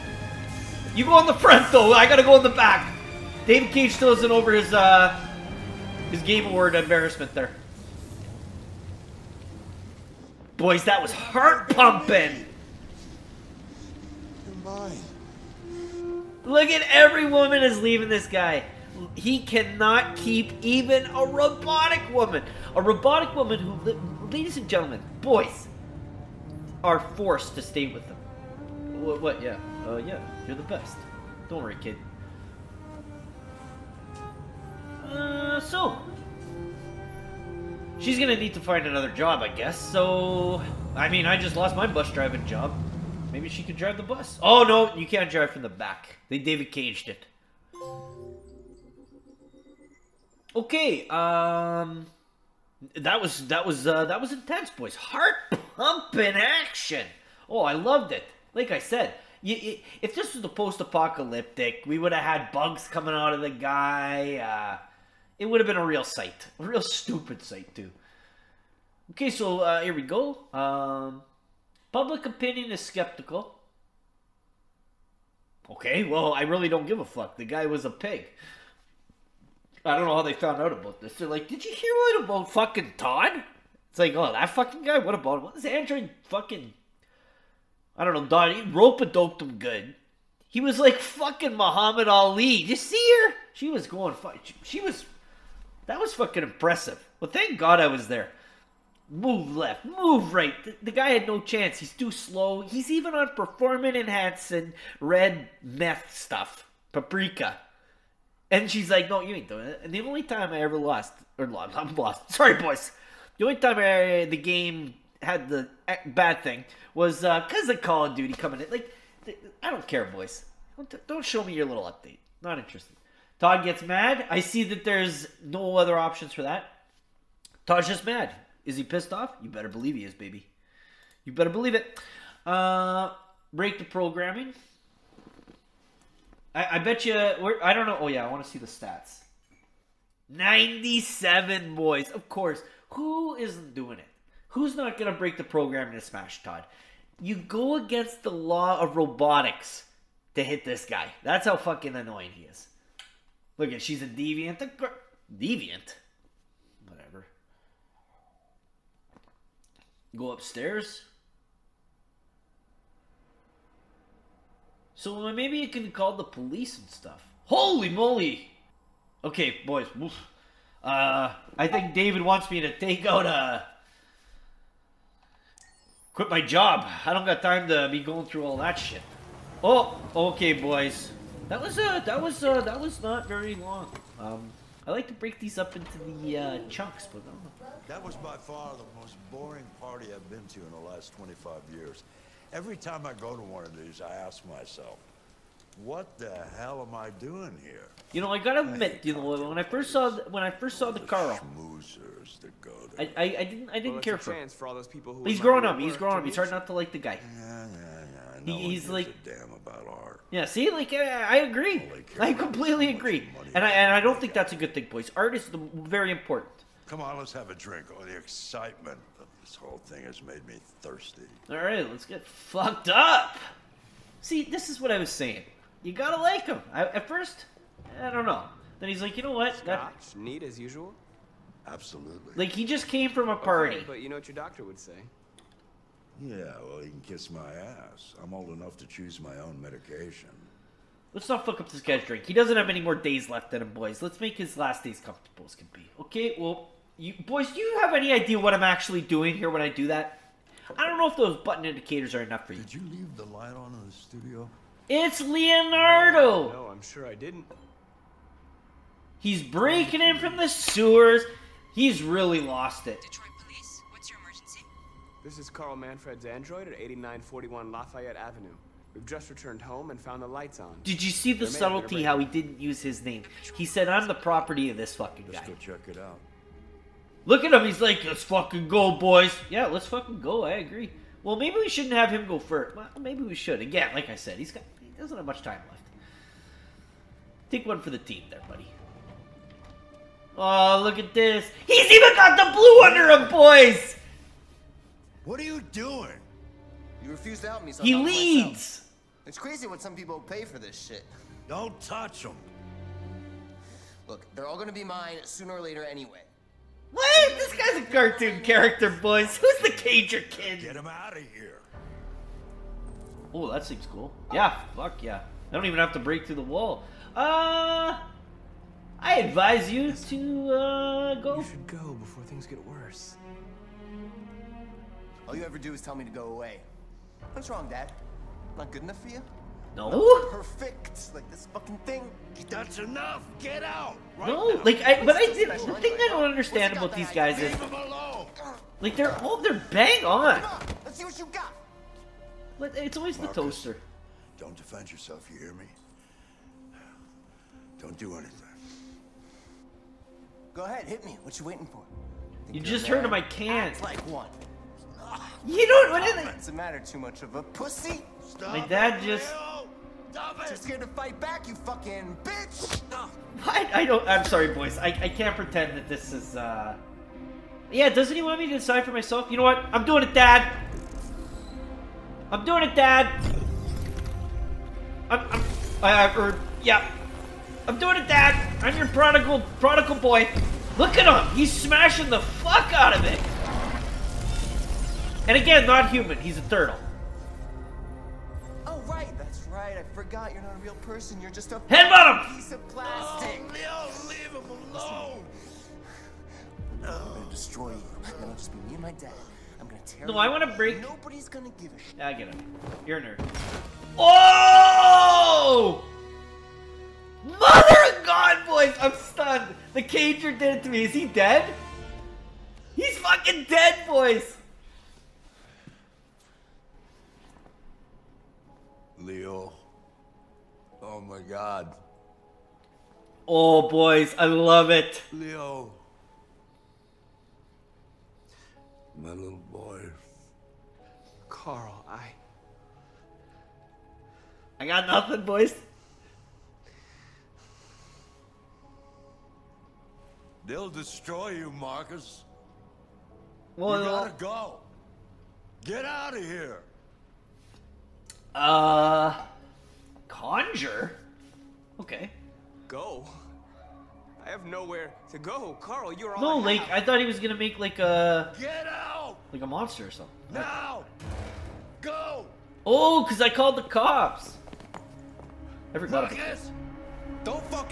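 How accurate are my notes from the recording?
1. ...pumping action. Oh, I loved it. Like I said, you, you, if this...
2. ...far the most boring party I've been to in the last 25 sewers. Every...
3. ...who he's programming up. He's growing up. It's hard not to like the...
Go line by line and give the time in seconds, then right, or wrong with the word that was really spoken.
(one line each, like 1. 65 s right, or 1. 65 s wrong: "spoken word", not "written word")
1. 55 s right
2. 188 s wrong: "years", not "sewers"
3. 205 s wrong: "growing", not "programming".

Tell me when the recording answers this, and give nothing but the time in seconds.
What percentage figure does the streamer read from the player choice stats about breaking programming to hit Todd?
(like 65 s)
140 s.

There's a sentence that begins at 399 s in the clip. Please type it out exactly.
I'm gonna tear No, I wanna break.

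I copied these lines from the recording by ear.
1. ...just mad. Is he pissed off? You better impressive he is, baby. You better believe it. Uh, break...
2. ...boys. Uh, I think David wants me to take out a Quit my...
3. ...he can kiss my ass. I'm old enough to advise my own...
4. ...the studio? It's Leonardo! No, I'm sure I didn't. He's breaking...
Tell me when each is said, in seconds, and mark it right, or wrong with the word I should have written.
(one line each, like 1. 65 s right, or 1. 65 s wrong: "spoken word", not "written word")
1. 127 s wrong: "believe", not "impressive"
2. 169 s right
3. 236 s wrong: "choose", not "advise"
4. 253 s right.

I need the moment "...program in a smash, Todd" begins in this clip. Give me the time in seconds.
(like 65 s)
145 s.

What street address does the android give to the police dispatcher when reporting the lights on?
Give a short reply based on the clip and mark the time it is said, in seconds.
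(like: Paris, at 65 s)
8941 Lafayette Avenue, at 266 s.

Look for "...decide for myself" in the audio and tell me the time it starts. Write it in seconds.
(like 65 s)
368 s.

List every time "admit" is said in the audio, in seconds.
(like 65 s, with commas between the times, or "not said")
198 s.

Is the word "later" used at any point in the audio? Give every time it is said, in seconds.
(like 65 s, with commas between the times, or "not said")
305 s.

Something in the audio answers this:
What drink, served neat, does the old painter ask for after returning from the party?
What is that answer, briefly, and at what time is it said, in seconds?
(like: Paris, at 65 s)
Scotch, at 229 s.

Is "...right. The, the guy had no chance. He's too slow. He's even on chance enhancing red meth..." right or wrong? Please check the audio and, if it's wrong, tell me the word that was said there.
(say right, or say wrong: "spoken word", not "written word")
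wrong: "performance", not "chance".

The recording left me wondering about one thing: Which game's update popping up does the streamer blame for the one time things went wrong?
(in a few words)
Call of Duty.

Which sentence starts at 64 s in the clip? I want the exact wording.
Uh, it would have been a real sight, a real stupid sight too.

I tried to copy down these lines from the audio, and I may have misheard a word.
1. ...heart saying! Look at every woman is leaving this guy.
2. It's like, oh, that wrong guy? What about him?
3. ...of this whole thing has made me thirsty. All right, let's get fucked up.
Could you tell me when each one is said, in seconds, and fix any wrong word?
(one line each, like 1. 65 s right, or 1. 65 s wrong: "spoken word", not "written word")
1. 11 s wrong: "pumping", not "saying"
2. 83 s wrong: "fucking", not "wrong"
3. 219 s right.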